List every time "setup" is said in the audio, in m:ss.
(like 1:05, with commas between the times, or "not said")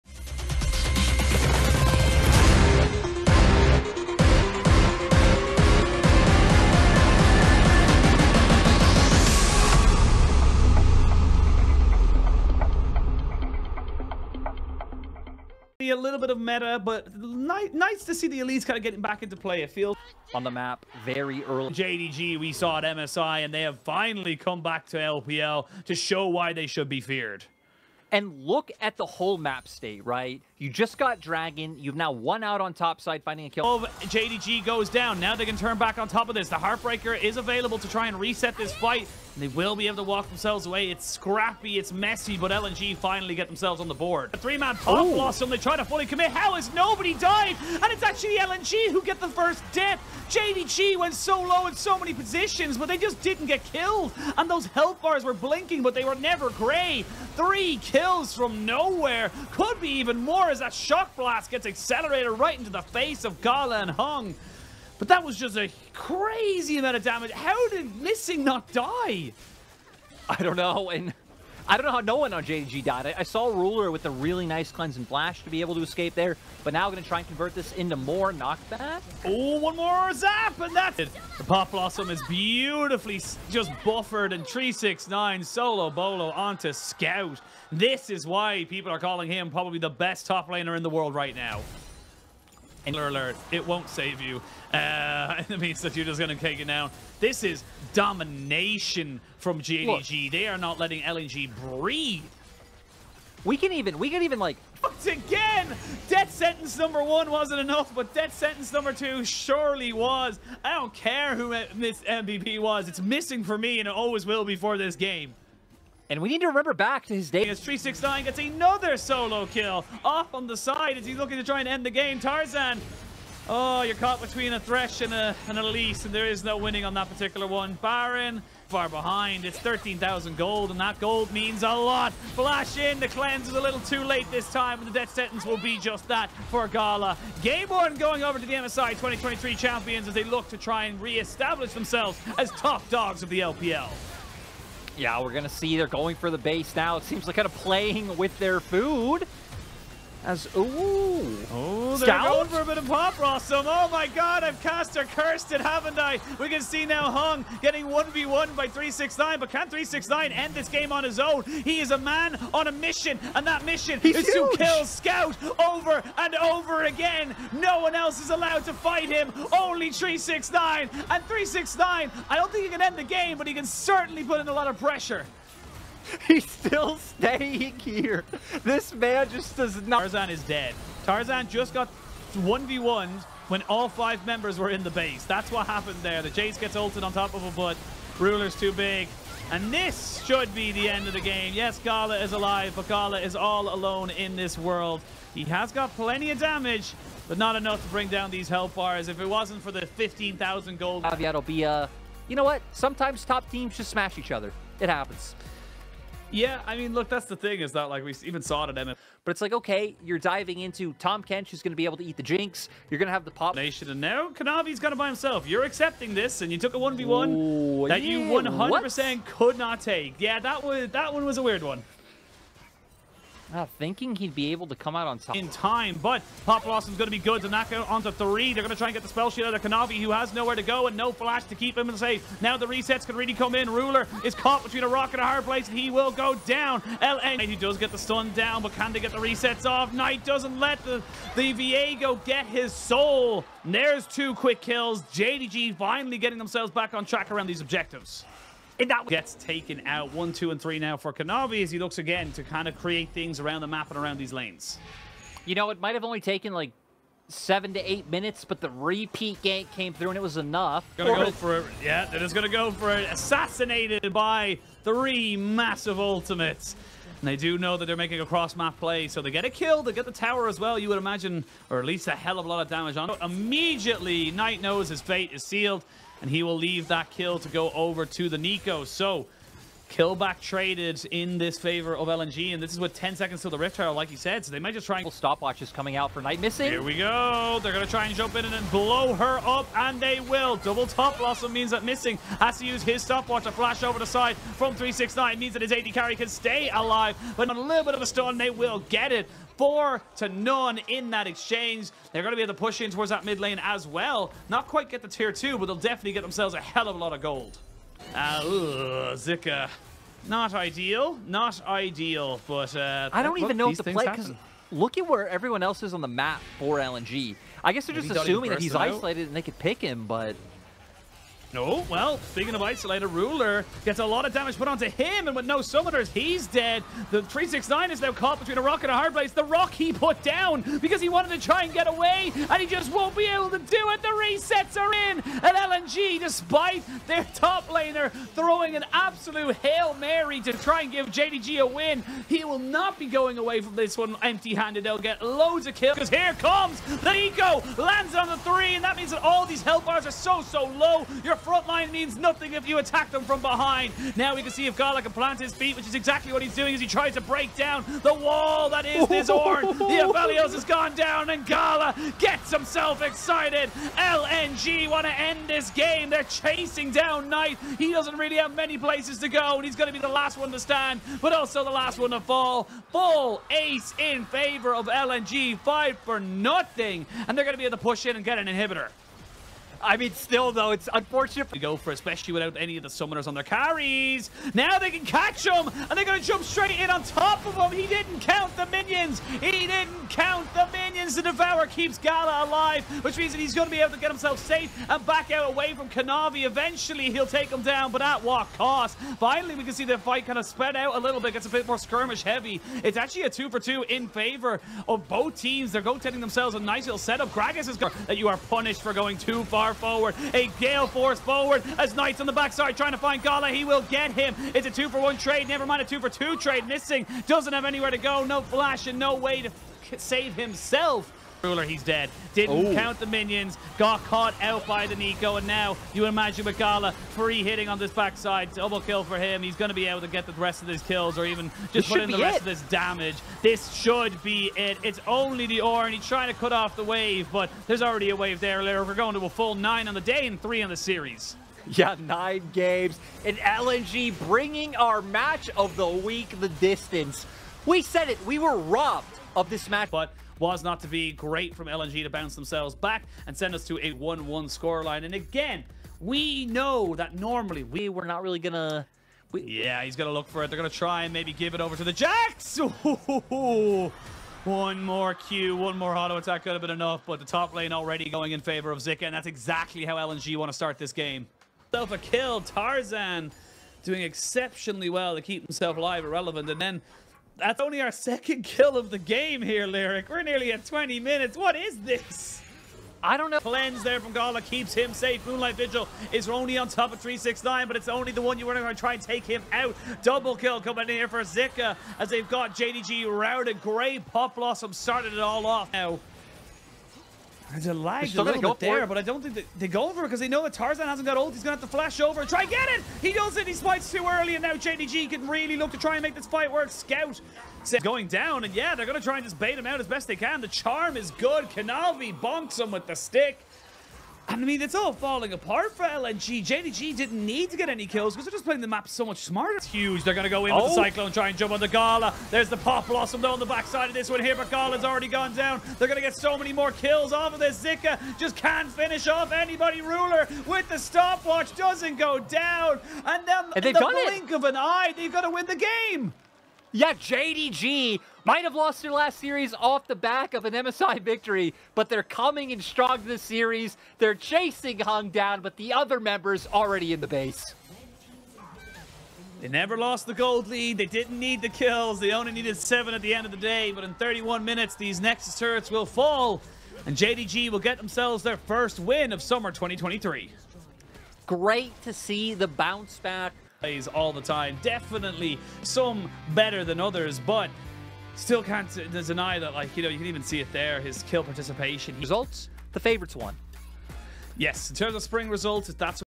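6:46.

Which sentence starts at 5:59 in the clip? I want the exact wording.
The Aphelios has gone down, and Gala gets himself excited.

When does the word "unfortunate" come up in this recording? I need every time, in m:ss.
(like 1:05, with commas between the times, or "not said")
6:20.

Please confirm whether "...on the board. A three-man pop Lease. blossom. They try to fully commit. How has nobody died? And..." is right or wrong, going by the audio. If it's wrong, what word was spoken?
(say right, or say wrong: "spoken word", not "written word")
wrong: "Ooh", not "Lease".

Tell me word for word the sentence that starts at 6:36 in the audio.
Eventually, he'll take him down, but at what cost?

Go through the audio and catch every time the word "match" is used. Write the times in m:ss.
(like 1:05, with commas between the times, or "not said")
7:25, 7:29.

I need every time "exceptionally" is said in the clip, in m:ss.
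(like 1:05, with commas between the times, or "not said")
7:54.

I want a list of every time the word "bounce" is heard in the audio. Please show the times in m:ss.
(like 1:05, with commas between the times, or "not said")
7:32, 9:22.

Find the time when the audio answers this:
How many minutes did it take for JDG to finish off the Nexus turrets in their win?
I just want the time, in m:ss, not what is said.
9:13.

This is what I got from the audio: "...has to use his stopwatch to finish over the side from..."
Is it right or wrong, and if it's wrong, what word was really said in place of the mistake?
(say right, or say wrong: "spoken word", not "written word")
wrong: "flash", not "finish".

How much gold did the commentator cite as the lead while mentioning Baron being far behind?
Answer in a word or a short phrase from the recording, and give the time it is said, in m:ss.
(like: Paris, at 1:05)
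13,000, at 2:09.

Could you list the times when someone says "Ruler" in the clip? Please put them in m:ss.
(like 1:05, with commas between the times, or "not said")
1:13, 3:08, 3:53, 5:23, 7:01, 8:49.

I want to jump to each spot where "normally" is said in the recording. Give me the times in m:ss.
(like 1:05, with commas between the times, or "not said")
7:37.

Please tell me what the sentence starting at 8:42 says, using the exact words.
There's the Pop Blossom, though, on the backside of this one here, but Gala's already gone down.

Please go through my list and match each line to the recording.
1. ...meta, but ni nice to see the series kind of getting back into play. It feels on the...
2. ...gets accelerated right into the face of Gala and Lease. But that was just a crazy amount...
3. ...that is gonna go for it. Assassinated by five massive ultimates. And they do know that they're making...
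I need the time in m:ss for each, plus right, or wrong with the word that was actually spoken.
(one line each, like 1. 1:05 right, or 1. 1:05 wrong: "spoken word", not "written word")
1. 0:16 wrong: "elites", not "series"
2. 1:01 wrong: "Hung", not "Lease"
3. 4:22 wrong: "three", not "five".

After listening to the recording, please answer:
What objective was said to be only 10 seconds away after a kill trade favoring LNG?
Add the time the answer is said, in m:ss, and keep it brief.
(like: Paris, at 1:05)
Rift Herald, at 4:43.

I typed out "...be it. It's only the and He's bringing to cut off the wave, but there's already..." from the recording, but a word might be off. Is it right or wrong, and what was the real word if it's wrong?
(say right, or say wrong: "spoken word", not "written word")
wrong: "trying", not "bringing".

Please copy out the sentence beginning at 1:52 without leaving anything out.
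It's missing for me, and it always will before this game.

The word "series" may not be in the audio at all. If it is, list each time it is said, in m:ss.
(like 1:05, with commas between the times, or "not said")
7:20, 8:59, 9:03.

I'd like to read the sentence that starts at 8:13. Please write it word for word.
Great Pop Blossom started it all off now.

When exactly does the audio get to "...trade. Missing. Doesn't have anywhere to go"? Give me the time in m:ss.
6:56.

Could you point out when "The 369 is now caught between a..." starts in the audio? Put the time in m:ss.
5:27.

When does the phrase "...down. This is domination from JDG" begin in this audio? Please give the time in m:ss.
1:36.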